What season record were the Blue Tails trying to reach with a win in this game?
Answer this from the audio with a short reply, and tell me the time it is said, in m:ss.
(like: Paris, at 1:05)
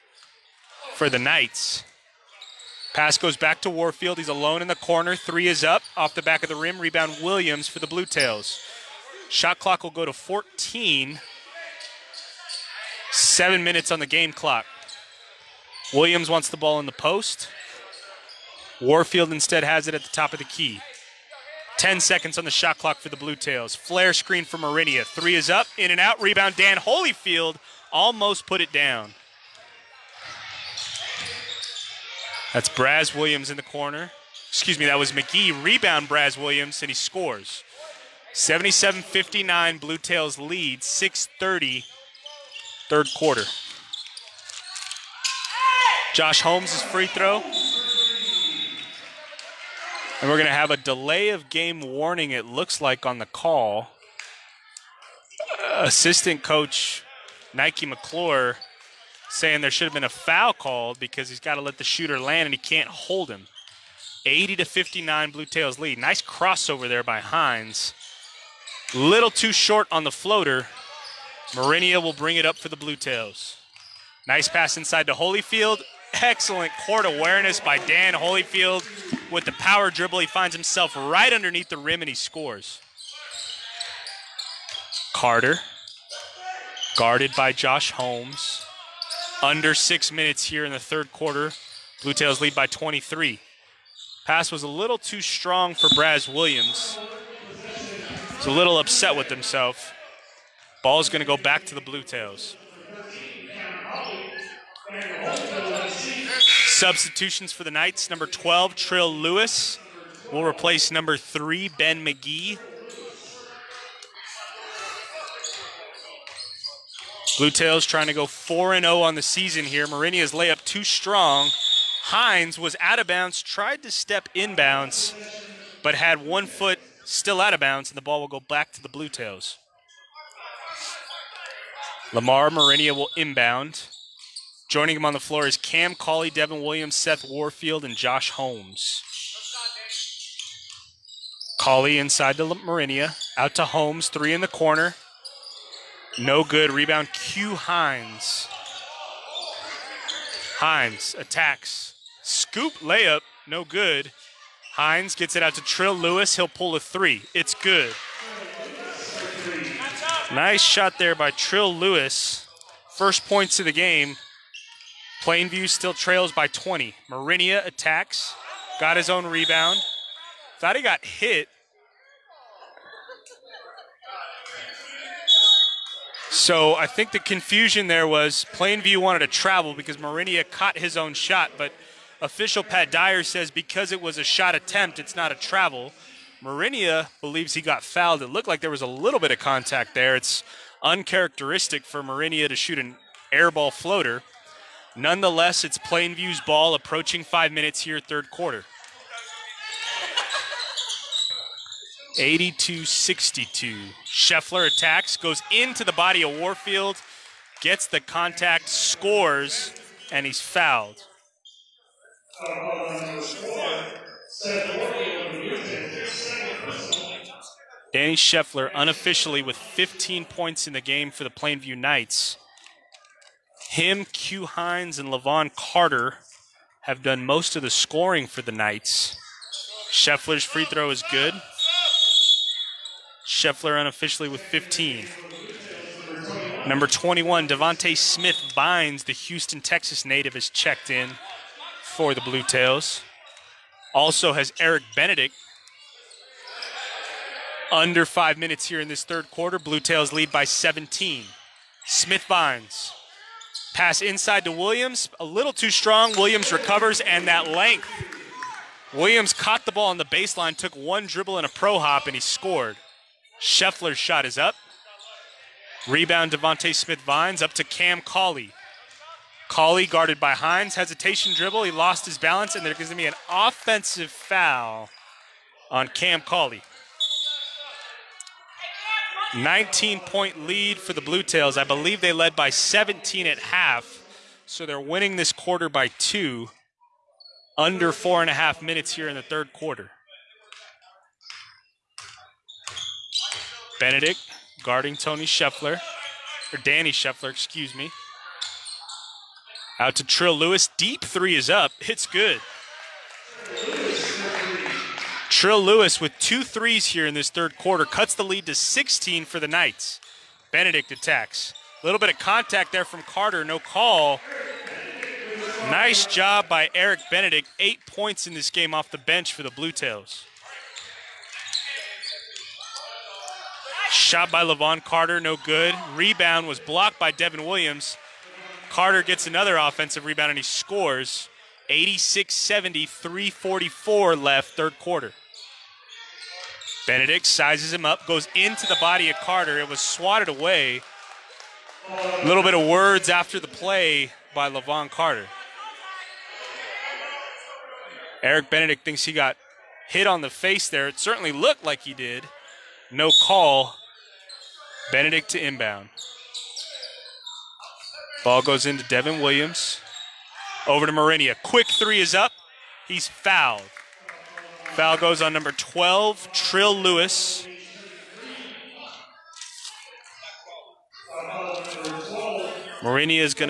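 4-0, at 1:58.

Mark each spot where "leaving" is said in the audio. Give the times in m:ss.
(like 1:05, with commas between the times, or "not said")
not said.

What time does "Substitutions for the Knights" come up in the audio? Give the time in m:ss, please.
1:46.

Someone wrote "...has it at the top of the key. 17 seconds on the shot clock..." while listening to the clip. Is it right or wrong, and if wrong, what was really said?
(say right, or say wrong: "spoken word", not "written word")
wrong: "10", not "17".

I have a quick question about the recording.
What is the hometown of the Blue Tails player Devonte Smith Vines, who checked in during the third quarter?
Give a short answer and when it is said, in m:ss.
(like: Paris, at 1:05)
Houston, Texas, at 3:59.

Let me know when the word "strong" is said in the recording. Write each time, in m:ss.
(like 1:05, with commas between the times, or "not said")
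1:35, 2:00, 4:15.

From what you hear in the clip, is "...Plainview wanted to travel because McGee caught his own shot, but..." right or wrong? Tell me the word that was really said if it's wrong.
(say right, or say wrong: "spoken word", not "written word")
wrong: "Marinia", not "McGee".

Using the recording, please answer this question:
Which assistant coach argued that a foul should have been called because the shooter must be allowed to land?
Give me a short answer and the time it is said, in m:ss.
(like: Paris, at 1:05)
Nike McClure, at 0:57.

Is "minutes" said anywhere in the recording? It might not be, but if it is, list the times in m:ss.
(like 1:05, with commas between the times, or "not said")
0:13, 1:30, 3:17, 4:08, 4:48.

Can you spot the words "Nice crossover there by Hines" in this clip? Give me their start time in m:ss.
1:05.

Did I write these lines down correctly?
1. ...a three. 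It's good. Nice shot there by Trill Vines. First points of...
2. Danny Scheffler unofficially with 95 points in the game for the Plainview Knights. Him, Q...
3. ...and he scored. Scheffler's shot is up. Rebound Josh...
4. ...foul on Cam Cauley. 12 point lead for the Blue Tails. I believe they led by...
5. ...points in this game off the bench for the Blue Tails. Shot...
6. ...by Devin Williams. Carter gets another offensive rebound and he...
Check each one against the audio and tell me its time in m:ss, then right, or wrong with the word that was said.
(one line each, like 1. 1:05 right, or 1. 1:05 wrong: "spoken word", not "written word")
1. 2:36 wrong: "Lewis", not "Vines"
2. 3:37 wrong: "15", not "95"
3. 4:22 wrong: "Devonte", not "Josh"
4. 4:34 wrong: "19", not "12"
5. 5:17 right
6. 5:26 right.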